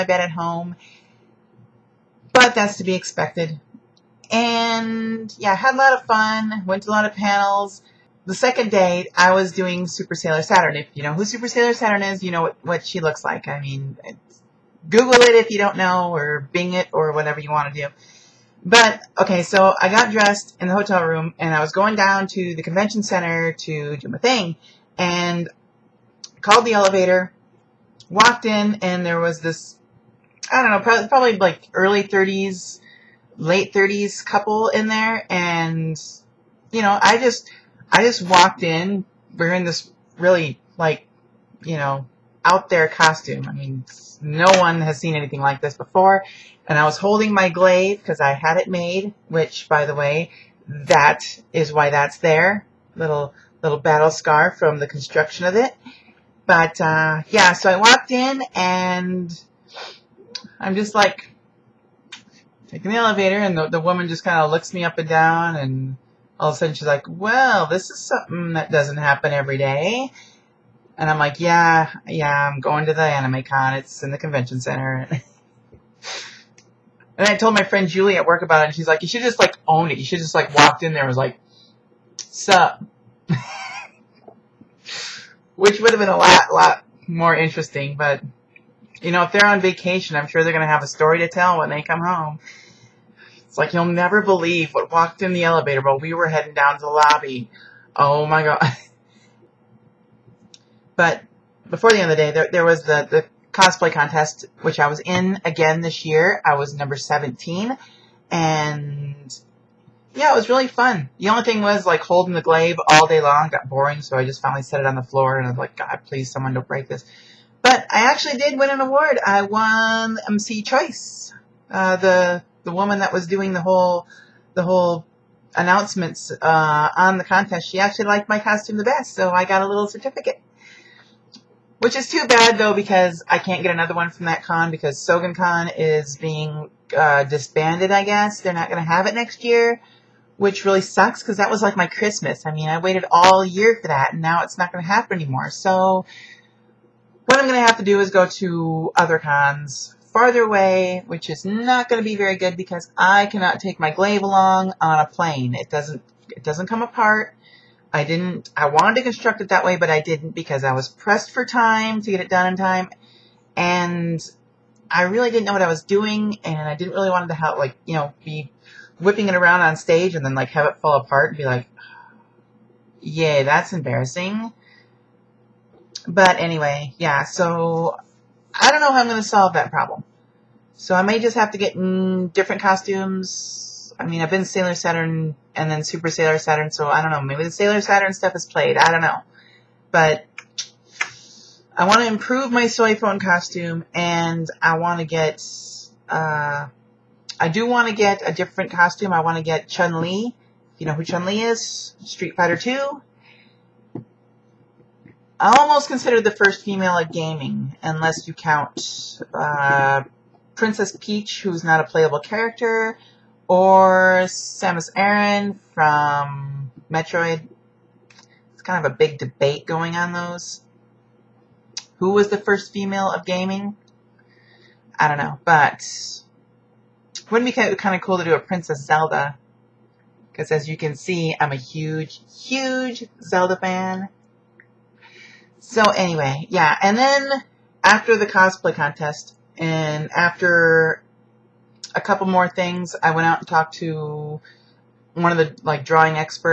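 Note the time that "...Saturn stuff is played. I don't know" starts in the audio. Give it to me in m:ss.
3:07.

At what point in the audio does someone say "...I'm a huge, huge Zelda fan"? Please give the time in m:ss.
3:51.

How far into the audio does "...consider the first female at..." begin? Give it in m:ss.
3:25.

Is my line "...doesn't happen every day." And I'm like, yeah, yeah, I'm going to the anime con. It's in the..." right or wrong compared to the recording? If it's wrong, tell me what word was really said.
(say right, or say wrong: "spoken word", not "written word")
right.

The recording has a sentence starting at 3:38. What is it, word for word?
It's kind of a big debate going on those.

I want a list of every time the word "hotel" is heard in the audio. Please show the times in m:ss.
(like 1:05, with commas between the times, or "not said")
0:20.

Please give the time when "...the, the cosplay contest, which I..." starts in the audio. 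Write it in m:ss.
1:42.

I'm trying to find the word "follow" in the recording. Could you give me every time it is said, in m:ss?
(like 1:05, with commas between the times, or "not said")
not said.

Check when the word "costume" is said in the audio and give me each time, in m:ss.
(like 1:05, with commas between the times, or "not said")
0:42, 2:08, 3:02, 3:13, 3:18.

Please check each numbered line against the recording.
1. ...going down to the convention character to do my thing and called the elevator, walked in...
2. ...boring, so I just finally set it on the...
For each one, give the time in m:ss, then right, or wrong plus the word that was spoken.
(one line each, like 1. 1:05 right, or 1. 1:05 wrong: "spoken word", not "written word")
1. 0:21 wrong: "center", not "character"
2. 1:53 right.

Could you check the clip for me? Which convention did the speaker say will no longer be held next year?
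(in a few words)
Sogan Con.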